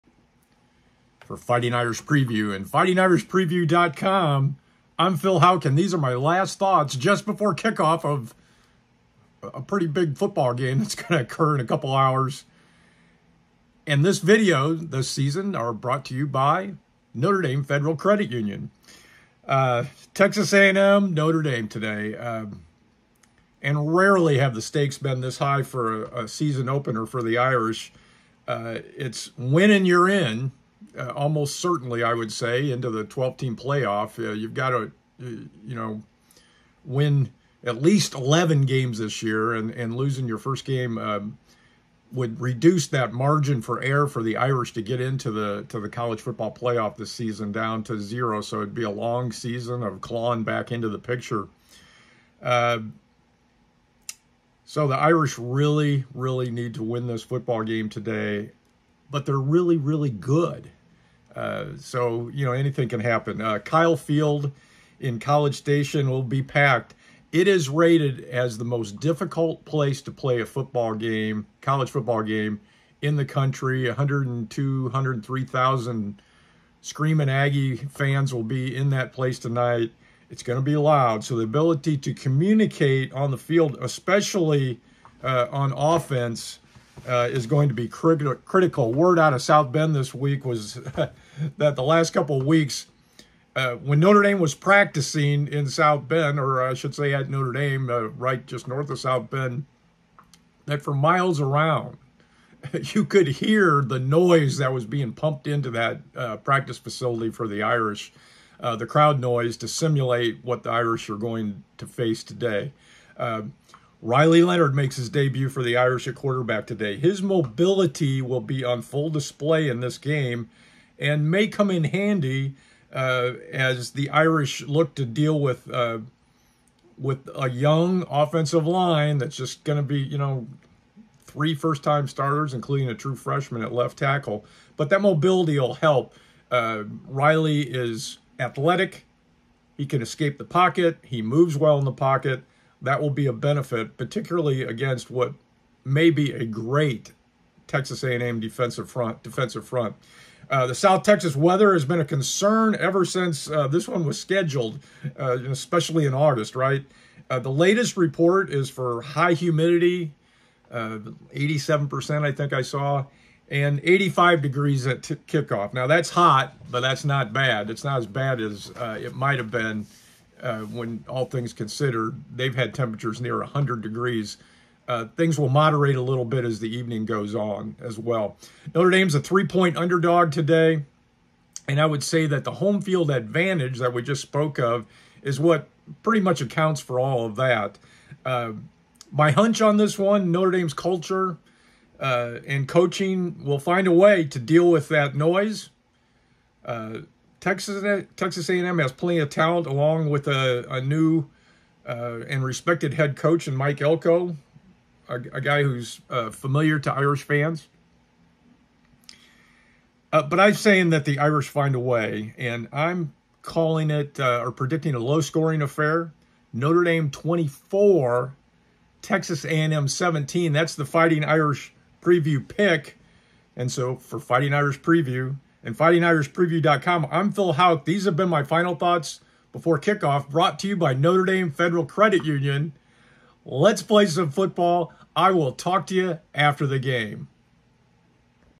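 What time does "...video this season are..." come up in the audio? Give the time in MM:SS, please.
00:14.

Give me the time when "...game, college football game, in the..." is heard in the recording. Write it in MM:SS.
01:10.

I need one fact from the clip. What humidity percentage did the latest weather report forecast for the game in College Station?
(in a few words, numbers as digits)
87%.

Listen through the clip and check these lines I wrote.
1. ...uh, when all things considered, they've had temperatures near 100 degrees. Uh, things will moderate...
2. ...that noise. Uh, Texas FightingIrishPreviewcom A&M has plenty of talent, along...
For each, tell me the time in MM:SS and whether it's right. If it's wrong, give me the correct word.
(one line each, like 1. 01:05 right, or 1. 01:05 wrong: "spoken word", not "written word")
1. 02:50 right
2. 03:14 wrong: "Texas", not "FightingIrishPreviewcom".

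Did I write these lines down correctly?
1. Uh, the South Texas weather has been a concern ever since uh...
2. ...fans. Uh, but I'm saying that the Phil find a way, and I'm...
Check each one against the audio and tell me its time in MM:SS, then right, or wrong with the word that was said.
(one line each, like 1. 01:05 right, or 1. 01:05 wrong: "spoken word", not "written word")
1. 02:30 right
2. 03:27 wrong: "Irish", not "Phil".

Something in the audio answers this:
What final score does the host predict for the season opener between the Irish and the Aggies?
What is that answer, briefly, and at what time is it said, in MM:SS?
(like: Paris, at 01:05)
Notre Dame 24, Texas A&M 17, at 03:36.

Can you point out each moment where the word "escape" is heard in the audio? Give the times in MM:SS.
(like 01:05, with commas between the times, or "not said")
02:20.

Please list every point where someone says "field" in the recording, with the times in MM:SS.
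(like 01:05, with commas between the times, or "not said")
01:03, 01:23, 03:02.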